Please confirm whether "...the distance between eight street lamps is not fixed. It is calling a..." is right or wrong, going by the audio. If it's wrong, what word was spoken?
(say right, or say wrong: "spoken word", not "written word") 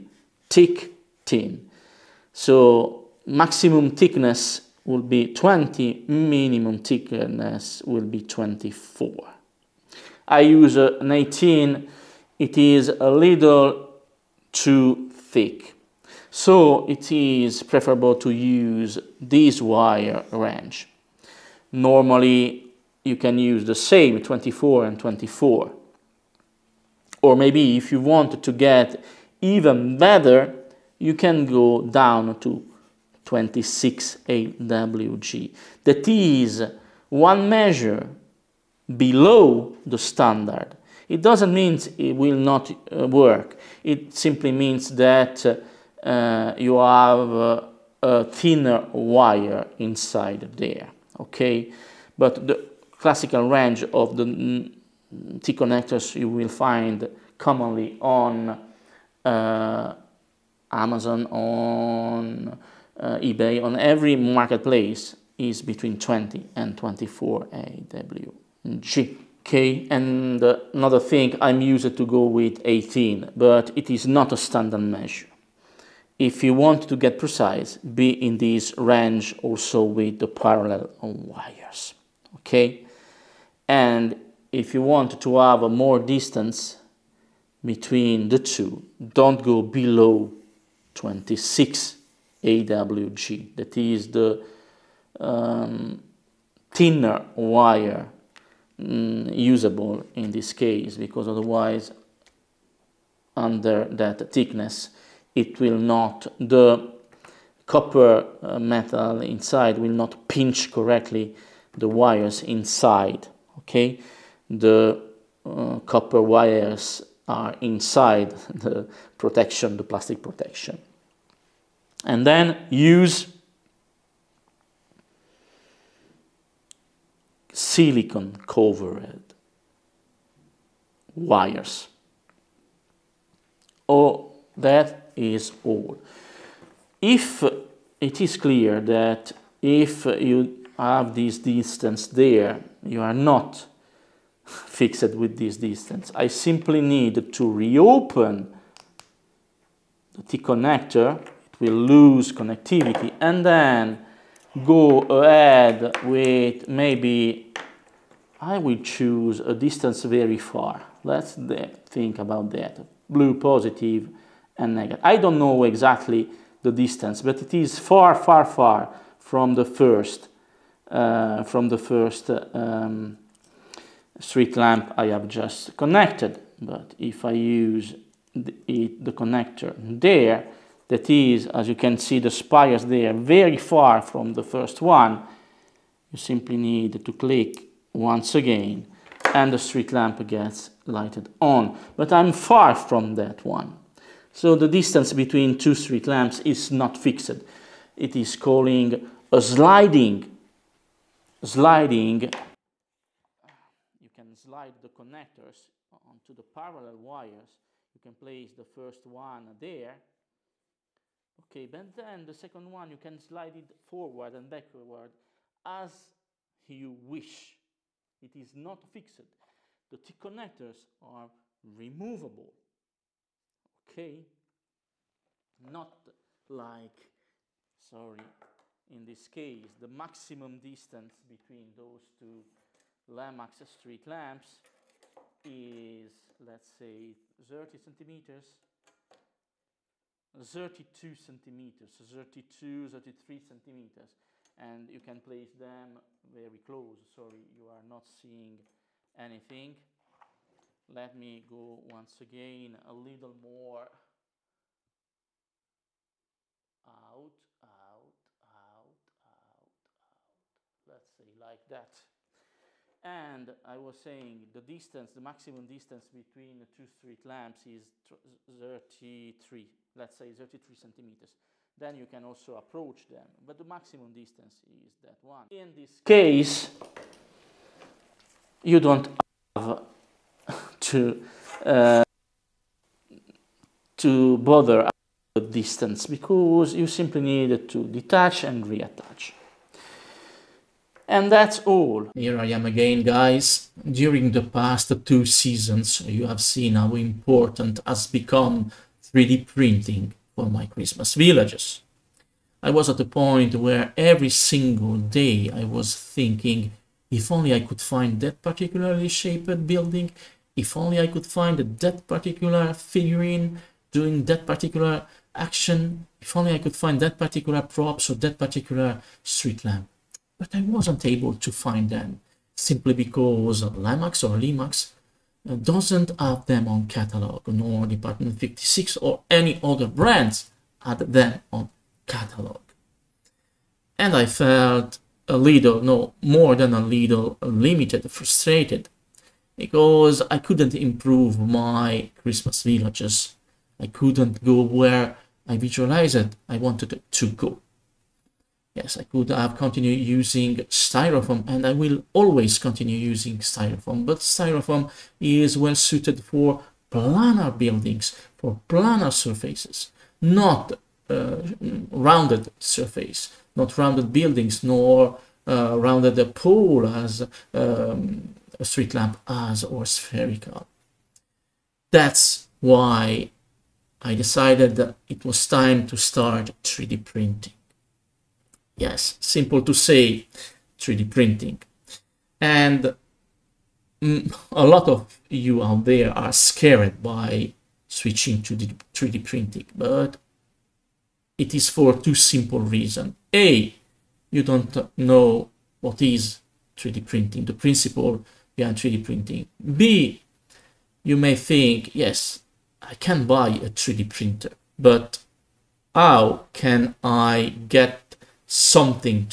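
wrong: "two", not "eight".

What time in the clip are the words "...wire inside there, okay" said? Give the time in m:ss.
0:48.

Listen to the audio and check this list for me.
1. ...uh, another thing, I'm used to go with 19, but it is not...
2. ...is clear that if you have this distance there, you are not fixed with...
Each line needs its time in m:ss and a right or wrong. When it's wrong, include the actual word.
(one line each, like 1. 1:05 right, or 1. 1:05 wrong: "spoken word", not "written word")
1. 1:10 wrong: "18", not "19"
2. 2:18 right.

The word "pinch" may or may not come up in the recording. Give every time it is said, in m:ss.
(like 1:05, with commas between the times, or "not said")
1:50.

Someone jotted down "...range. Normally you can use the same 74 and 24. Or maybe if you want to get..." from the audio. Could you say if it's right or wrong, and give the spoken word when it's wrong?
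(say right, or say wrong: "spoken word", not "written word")
wrong: "24", not "74".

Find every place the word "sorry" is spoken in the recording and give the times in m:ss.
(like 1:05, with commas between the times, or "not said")
3:47, 4:07.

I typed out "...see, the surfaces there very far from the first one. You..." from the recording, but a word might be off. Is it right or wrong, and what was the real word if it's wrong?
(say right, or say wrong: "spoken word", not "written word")
wrong: "spires", not "surfaces".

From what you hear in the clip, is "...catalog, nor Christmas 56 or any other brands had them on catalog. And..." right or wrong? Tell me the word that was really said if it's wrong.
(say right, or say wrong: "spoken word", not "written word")
wrong: "Department", not "Christmas".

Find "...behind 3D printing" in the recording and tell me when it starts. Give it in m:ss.
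6:38.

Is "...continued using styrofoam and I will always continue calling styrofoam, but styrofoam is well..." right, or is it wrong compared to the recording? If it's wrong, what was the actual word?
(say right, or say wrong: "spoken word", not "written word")
wrong: "using", not "calling".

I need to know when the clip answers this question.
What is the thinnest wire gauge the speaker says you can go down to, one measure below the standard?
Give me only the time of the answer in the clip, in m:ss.
0:33.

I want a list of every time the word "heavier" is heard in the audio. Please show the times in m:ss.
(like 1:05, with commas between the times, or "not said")
not said.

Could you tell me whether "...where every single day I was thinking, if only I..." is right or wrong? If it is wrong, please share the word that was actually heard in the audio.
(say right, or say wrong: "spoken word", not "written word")
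right.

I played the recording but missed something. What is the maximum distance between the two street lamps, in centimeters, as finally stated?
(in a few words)
33 centimeters.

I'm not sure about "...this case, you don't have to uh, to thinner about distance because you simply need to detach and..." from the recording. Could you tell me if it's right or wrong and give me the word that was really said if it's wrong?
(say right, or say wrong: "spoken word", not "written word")
wrong: "bother", not "thinner".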